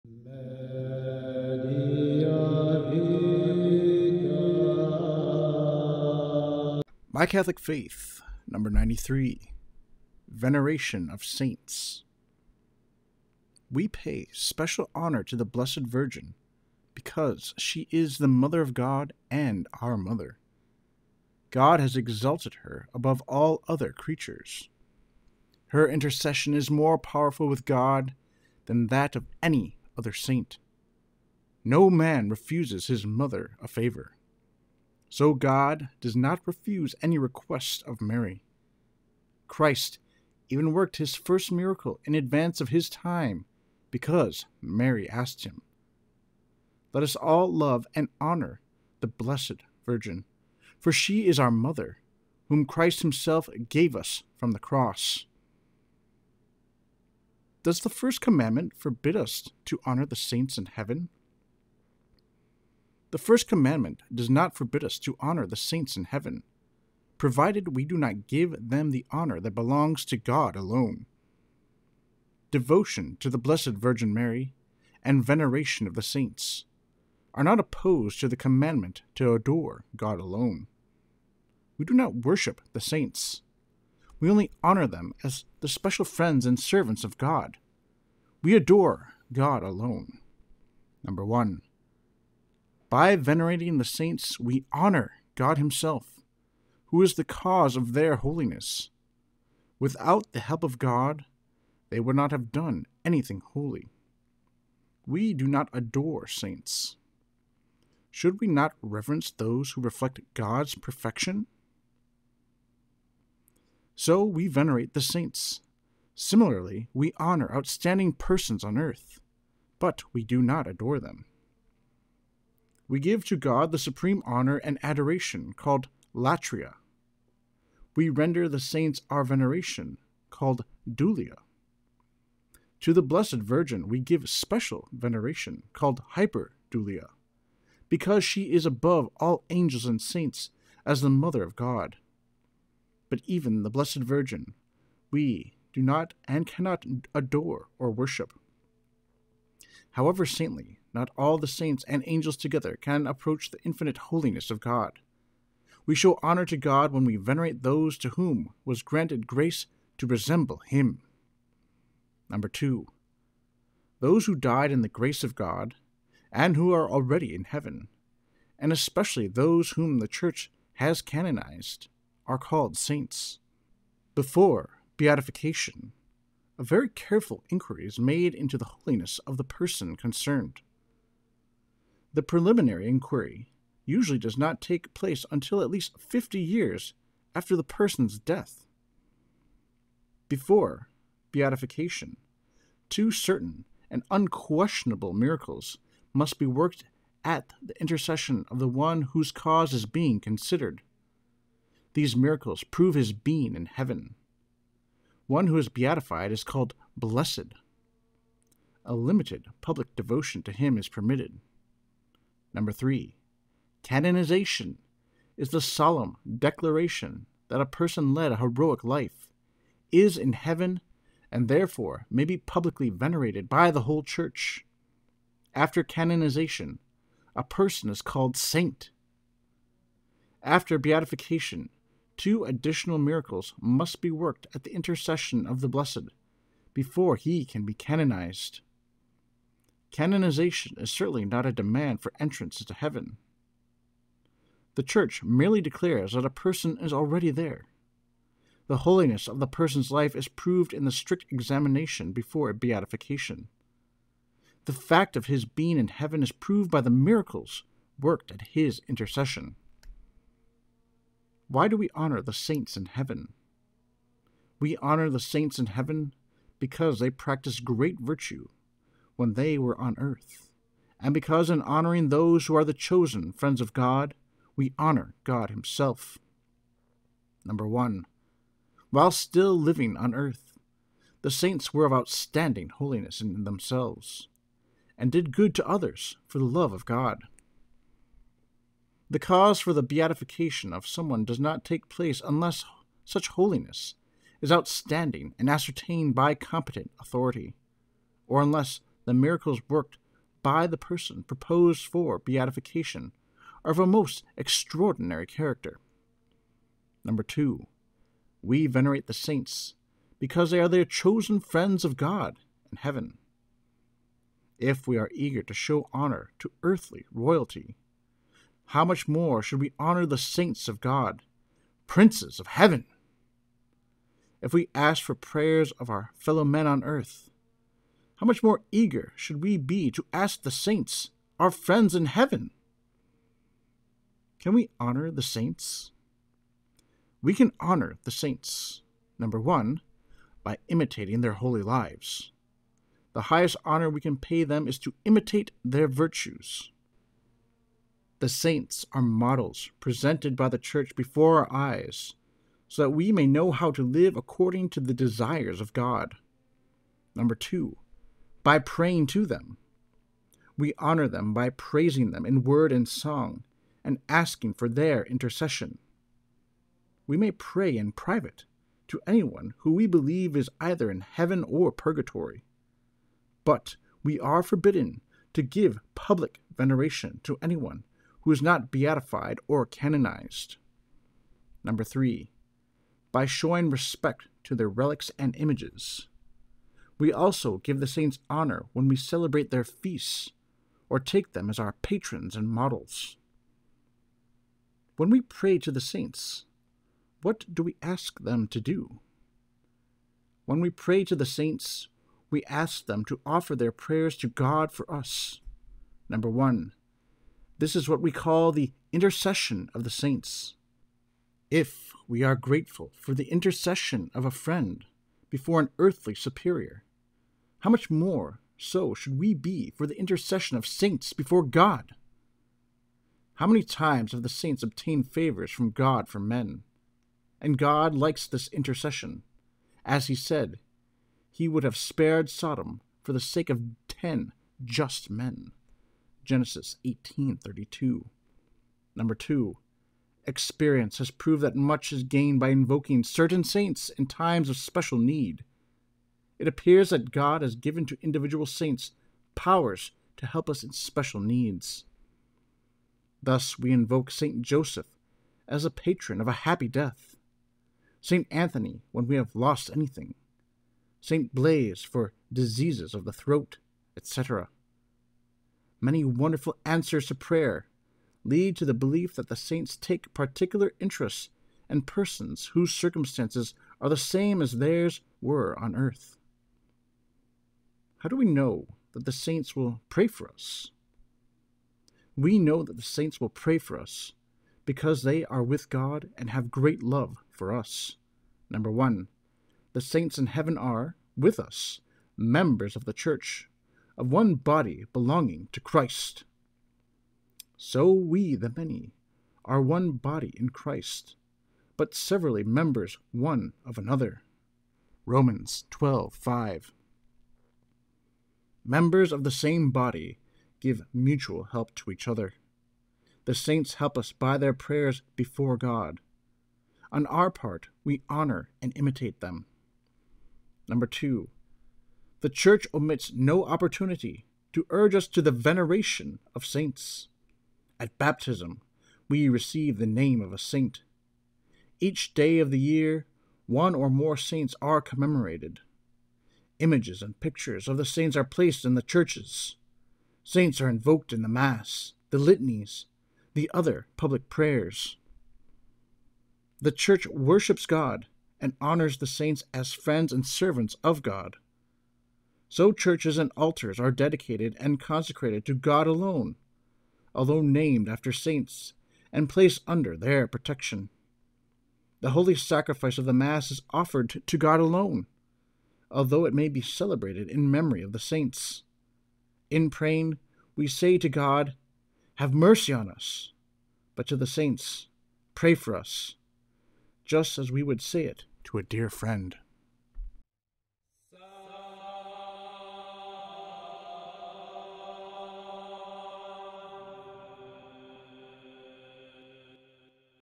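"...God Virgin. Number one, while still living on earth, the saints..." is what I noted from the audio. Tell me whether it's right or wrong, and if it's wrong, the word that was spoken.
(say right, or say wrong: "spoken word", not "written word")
wrong: "Himself", not "Virgin".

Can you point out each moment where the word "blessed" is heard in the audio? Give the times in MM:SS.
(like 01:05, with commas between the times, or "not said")
00:15, 00:49, 01:13, 02:13, 02:23, 03:26, 03:55.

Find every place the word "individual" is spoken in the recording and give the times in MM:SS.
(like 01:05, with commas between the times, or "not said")
07:28.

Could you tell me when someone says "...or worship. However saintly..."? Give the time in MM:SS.
02:27.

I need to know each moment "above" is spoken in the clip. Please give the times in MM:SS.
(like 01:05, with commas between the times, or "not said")
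00:22, 02:18.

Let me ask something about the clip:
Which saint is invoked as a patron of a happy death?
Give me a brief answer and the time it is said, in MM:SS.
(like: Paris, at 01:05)
St. Joseph, at 07:34.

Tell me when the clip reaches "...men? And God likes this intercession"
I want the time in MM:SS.
07:06.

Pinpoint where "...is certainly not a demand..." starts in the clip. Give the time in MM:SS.
04:00.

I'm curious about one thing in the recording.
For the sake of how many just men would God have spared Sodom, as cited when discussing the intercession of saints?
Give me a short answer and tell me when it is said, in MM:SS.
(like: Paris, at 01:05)
10, at 07:13.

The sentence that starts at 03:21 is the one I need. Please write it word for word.
These miracles prove his being in heaven.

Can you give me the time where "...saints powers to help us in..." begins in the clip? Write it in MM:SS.
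07:28.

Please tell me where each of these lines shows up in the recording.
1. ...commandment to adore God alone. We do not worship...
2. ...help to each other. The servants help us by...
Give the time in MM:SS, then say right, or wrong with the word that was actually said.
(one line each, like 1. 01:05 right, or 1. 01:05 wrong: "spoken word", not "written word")
1. 01:18 right
2. 08:31 wrong: "saints", not "servants".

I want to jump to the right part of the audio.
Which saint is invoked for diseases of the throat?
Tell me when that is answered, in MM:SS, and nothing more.
07:41.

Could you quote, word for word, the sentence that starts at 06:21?
Number three, by showing respect to their relics and images.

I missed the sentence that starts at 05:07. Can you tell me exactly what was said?
Number two, we venerate the saints because they are their chosen friends of God and heaven.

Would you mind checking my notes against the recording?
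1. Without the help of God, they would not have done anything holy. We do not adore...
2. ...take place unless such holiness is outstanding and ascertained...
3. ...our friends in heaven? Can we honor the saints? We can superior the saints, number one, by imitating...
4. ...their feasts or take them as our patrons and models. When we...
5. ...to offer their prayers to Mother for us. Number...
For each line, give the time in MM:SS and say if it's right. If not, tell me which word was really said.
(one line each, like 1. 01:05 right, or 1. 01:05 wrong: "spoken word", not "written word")
1. 01:39 right
2. 04:51 right
3. 05:31 wrong: "honor", not "superior"
4. 06:29 right
5. 06:43 wrong: "God", not "Mother".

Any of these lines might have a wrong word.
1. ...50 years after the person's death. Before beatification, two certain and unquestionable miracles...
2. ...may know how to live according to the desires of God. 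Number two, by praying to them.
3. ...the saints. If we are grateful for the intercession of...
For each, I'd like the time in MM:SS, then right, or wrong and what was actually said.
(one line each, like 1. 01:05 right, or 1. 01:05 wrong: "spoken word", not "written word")
1. 03:05 right
2. 05:53 right
3. 06:49 right.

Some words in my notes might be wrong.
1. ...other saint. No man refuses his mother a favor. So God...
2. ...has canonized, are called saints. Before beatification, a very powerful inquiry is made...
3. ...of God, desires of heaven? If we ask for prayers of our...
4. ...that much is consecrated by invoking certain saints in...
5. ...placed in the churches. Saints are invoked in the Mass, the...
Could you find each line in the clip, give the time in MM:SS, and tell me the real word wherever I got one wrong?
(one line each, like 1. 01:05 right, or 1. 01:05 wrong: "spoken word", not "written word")
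1. 00:29 right
2. 02:50 wrong: "careful", not "powerful"
3. 05:20 wrong: "princes", not "desires"
4. 07:21 wrong: "gained", not "consecrated"
5. 08:58 right.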